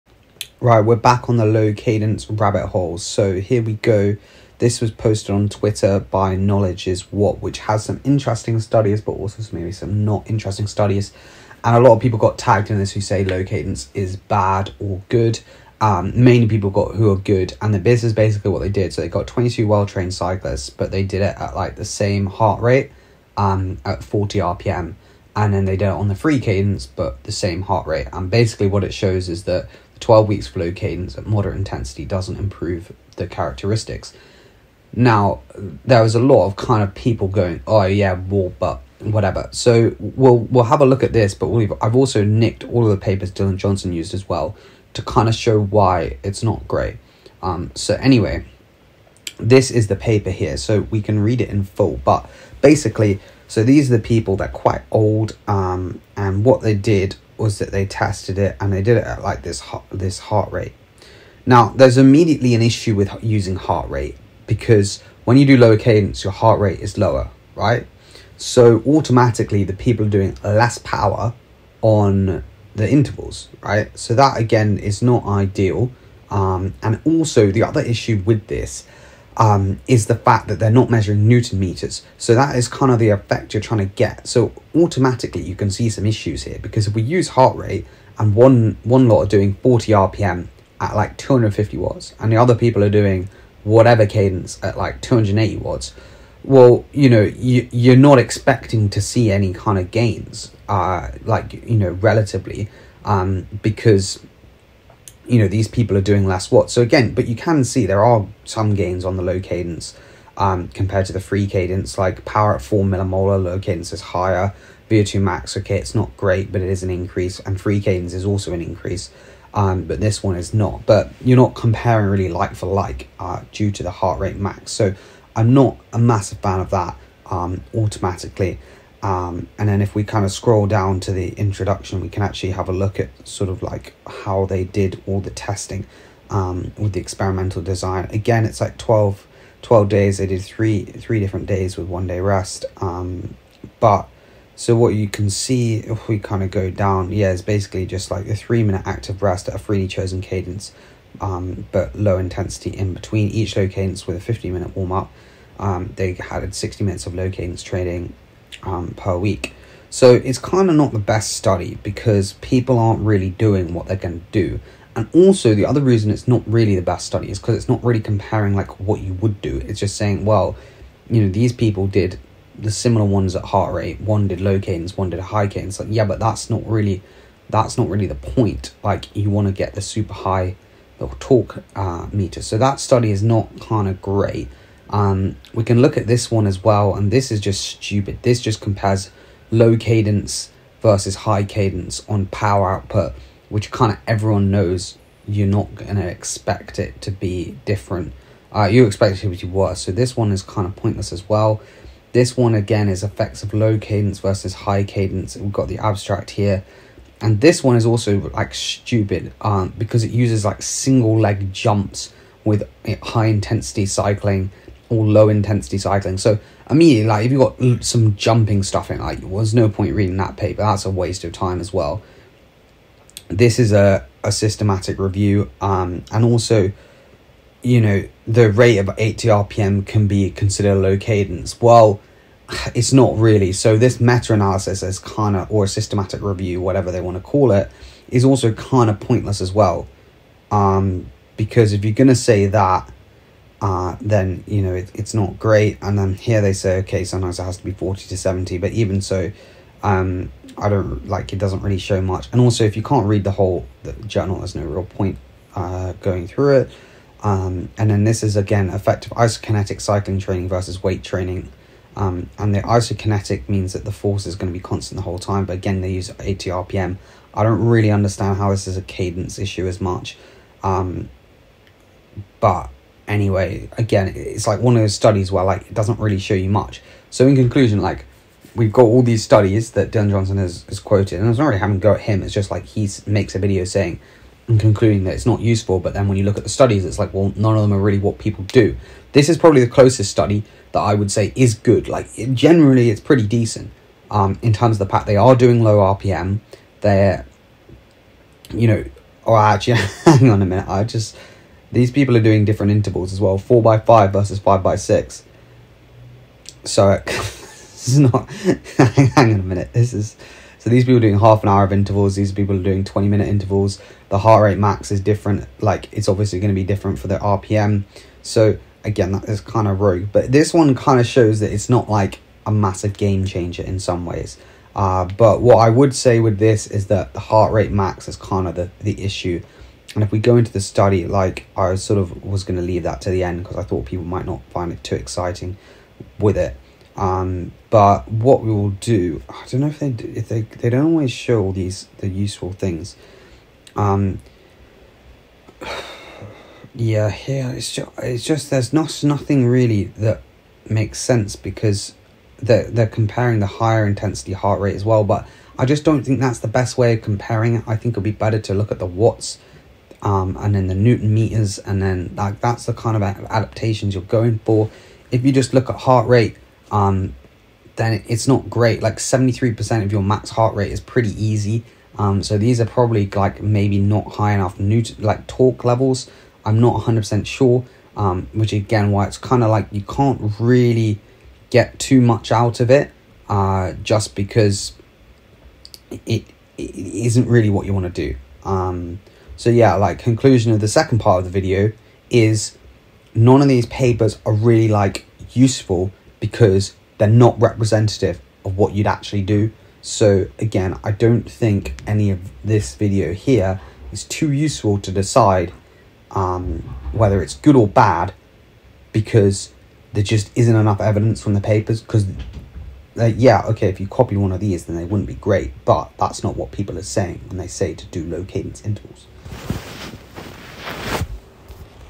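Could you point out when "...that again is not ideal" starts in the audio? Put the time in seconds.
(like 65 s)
74 s.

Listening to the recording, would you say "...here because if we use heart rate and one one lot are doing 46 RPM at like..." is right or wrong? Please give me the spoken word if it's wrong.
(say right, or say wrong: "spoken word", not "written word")
wrong: "40", not "46".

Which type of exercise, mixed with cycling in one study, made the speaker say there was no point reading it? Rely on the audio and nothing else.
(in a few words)
Single leg jumps.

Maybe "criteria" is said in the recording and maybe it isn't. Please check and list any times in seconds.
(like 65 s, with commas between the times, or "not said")
not said.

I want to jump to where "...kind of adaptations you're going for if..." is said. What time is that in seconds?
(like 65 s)
362 s.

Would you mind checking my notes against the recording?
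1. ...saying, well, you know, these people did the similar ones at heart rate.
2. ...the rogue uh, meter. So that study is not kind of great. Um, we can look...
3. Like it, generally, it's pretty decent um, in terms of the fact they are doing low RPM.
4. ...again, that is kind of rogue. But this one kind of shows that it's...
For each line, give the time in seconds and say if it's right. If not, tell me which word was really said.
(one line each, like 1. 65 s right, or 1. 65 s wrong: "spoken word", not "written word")
1. 169 s right
2. 180 s wrong: "torque", not "rogue"
3. 291 s right
4. 318 s right.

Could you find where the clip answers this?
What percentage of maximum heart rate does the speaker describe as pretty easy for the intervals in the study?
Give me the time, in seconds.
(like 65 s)
368 s.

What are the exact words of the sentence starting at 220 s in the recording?
That's a waste of time as well.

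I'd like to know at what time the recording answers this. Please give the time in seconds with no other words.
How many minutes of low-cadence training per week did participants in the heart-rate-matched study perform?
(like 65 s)
156 s.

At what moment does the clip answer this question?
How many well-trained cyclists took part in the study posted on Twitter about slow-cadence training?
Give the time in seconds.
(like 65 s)
19 s.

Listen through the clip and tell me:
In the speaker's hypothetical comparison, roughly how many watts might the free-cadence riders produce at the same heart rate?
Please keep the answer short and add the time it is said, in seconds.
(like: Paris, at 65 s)
280 watts, at 95 s.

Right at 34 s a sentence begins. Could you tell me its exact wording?
Now, there was a lot of kind of people going, oh, yeah, well, but whatever.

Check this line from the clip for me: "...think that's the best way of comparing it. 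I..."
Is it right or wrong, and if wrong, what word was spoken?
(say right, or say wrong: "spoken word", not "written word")
right.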